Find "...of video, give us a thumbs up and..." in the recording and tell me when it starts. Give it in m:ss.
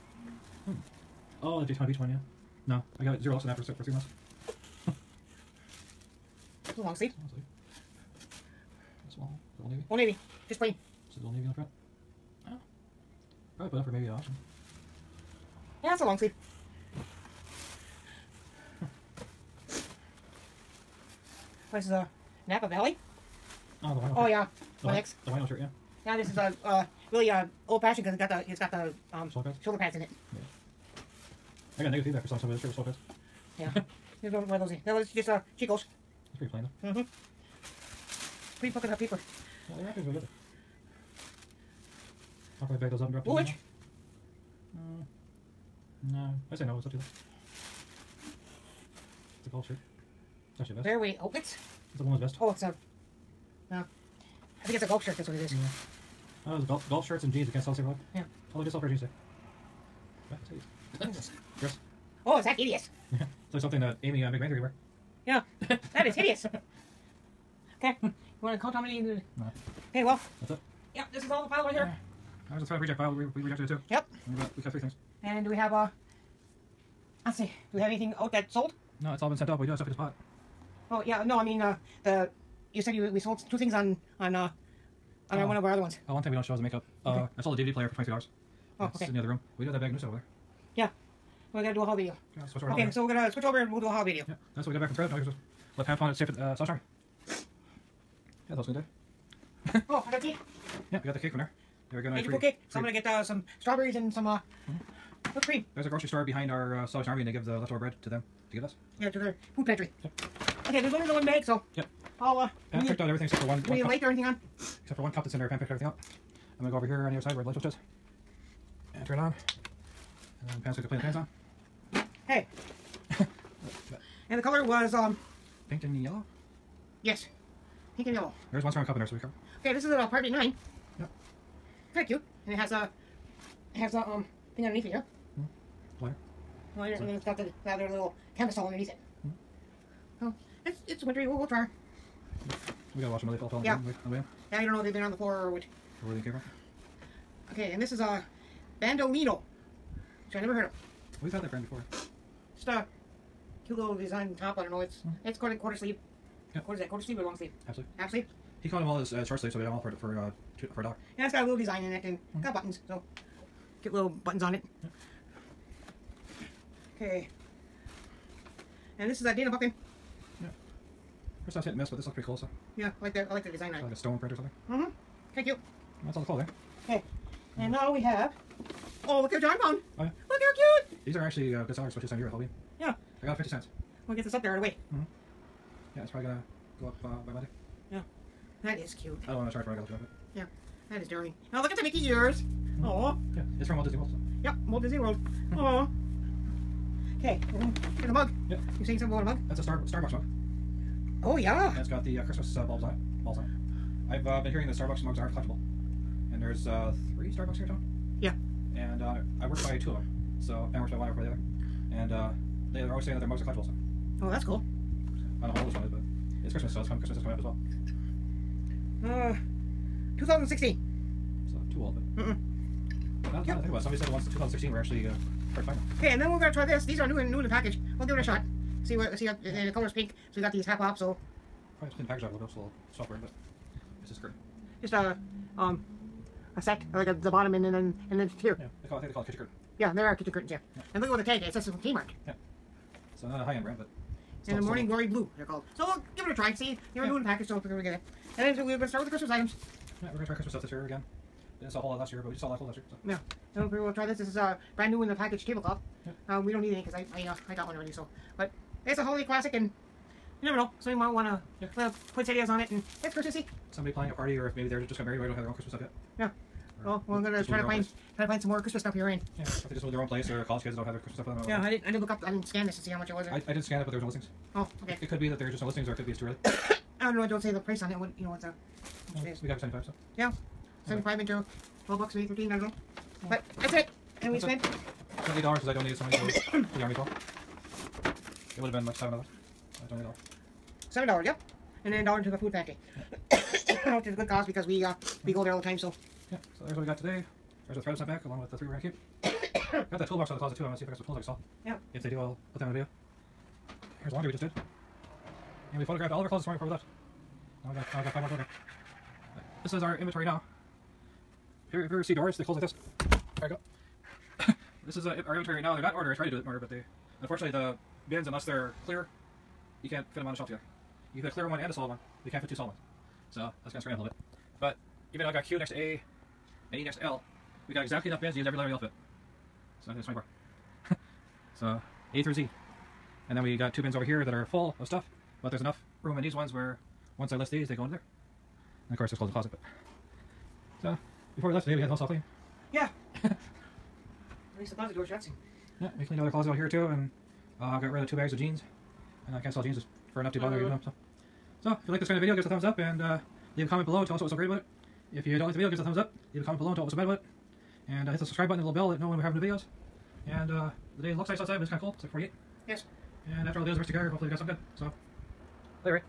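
5:52.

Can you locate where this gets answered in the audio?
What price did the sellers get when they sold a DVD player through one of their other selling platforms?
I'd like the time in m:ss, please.
1:27.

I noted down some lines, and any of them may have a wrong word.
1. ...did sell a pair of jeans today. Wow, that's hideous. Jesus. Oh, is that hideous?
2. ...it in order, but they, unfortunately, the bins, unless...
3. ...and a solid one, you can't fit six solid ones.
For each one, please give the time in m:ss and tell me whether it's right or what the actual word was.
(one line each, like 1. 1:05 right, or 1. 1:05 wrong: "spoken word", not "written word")
1. 0:58 right
2. 5:16 right
3. 5:21 wrong: "two", not "six".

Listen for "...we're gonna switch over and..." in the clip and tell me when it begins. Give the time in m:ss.
1:33.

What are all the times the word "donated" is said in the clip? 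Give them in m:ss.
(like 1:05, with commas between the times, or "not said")
4:45, 4:49.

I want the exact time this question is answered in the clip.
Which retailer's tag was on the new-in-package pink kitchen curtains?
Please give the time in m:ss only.
4:01.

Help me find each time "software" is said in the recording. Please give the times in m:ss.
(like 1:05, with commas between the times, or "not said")
3:52.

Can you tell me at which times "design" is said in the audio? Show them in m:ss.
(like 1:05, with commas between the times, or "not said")
2:33, 2:41, 2:53.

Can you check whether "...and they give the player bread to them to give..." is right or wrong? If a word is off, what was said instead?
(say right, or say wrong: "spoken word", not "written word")
wrong: "leftover", not "player".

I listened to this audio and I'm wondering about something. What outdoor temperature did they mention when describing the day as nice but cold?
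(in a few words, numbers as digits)
48.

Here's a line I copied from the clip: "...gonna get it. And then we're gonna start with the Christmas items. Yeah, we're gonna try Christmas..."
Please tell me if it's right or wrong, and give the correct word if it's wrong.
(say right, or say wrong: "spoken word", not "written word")
right.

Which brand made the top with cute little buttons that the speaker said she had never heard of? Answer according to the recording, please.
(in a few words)
Bandolino.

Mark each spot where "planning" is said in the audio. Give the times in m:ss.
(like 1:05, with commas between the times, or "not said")
4:23.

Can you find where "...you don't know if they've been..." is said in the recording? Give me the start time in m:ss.
2:24.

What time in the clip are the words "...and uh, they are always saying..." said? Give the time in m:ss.
3:31.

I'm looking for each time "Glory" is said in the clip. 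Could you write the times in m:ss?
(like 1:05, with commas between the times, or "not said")
4:04.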